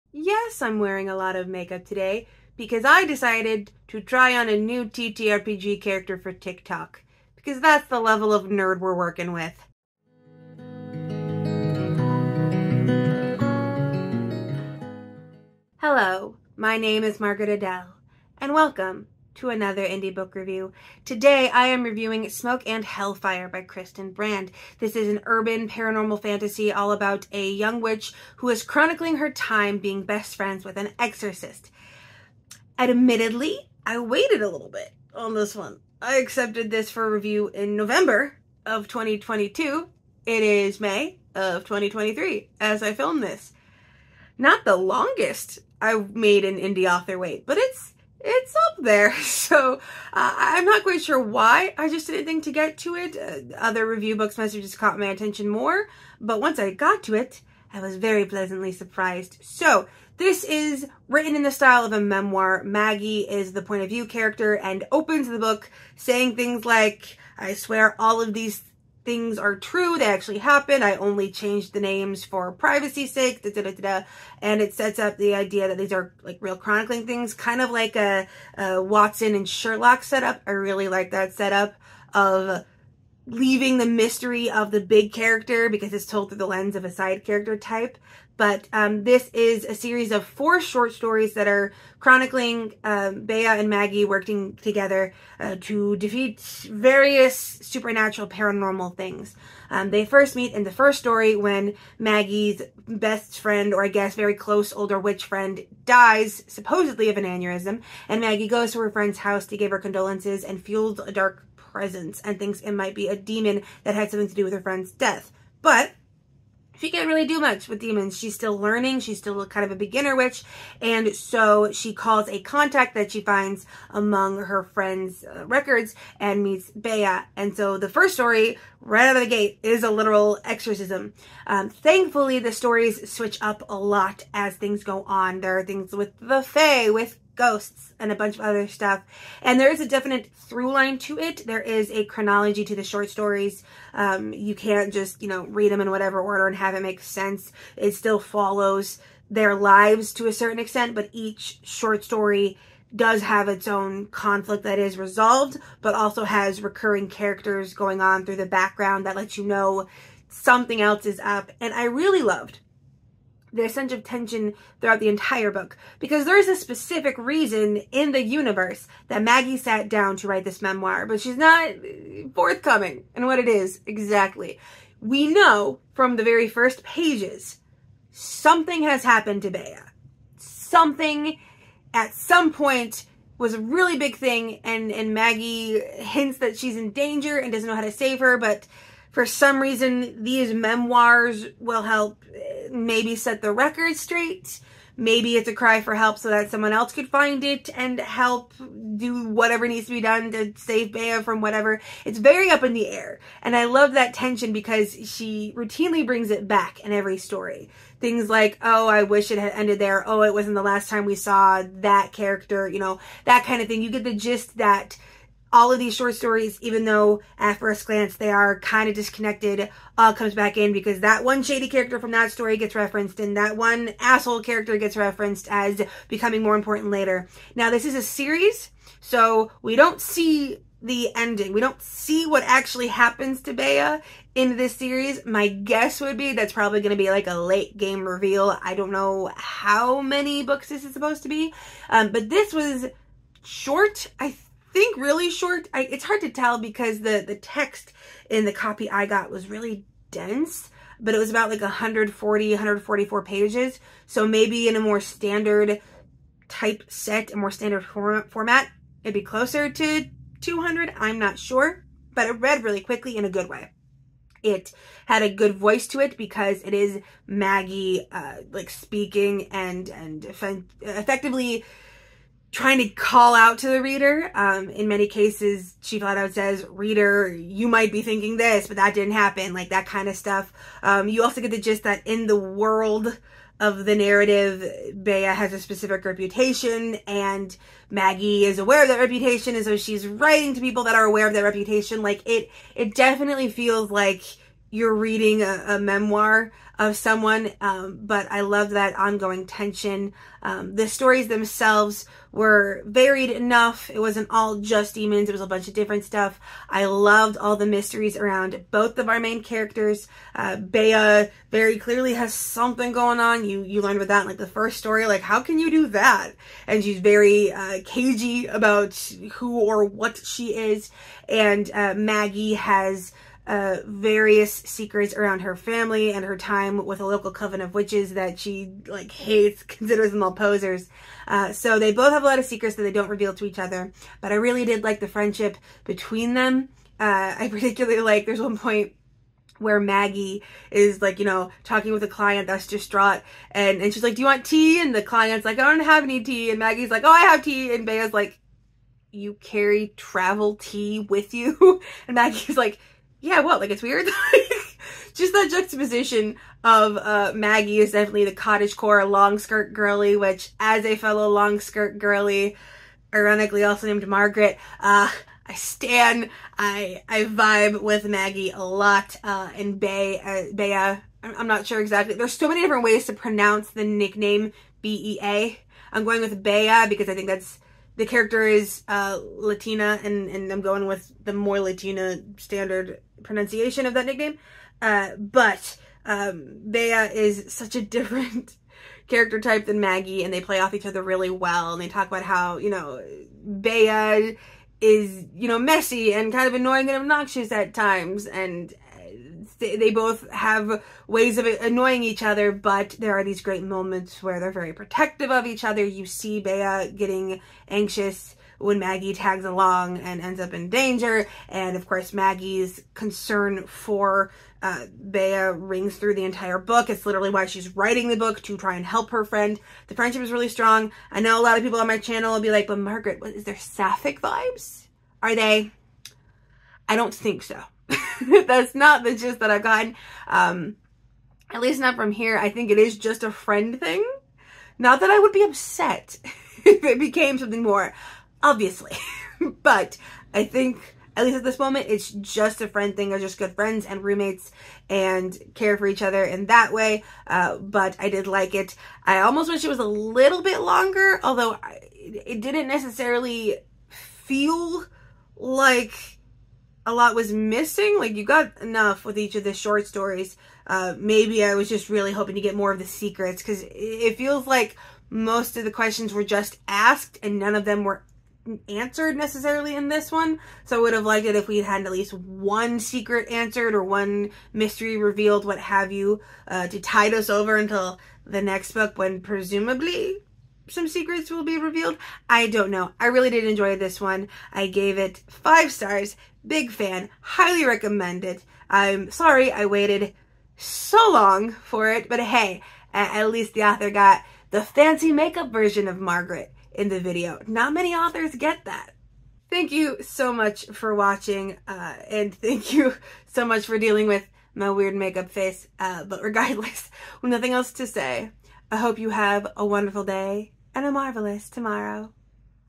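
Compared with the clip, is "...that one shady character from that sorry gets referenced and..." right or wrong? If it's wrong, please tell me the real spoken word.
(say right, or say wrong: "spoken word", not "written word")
wrong: "story", not "sorry".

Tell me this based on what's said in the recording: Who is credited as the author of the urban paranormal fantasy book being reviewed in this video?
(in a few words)
Kristen Brand.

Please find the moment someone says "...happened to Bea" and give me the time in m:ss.
2:59.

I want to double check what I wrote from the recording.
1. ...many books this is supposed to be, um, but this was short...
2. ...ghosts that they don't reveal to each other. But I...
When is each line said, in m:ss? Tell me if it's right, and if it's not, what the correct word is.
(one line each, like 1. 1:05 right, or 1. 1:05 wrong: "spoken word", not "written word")
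1. 4:00 right
2. 5:32 wrong: "secrets", not "ghosts".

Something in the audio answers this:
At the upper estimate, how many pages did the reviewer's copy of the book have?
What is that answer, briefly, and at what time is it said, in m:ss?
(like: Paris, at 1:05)
144, at 4:12.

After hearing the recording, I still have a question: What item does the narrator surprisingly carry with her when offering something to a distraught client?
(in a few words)
travel tea.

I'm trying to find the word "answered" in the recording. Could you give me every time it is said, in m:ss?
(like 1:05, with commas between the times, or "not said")
7:48, 7:53.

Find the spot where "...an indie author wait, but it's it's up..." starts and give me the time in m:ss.
0:46.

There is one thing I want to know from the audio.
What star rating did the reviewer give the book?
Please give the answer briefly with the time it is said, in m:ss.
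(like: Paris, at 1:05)
5 stars, at 8:05.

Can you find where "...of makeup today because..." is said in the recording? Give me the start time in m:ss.
0:01.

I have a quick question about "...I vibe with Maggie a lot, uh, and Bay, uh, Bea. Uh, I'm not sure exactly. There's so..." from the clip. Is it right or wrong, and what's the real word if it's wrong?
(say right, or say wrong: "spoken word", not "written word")
right.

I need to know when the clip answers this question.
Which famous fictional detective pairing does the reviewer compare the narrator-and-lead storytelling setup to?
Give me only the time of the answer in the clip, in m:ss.
1:18.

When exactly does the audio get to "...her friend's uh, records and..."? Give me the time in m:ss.
2:04.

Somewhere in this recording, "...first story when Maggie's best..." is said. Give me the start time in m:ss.
1:40.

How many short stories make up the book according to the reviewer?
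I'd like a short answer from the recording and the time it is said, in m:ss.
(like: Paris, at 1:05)
4, at 1:30.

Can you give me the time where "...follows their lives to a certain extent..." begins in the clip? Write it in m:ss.
2:28.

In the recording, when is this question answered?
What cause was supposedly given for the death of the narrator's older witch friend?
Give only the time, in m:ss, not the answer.
1:47.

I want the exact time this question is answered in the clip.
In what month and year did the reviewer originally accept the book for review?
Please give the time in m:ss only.
0:37.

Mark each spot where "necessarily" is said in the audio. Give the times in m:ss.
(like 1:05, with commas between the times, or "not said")
7:32, 7:49.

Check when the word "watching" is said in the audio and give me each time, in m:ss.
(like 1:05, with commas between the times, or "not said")
8:20.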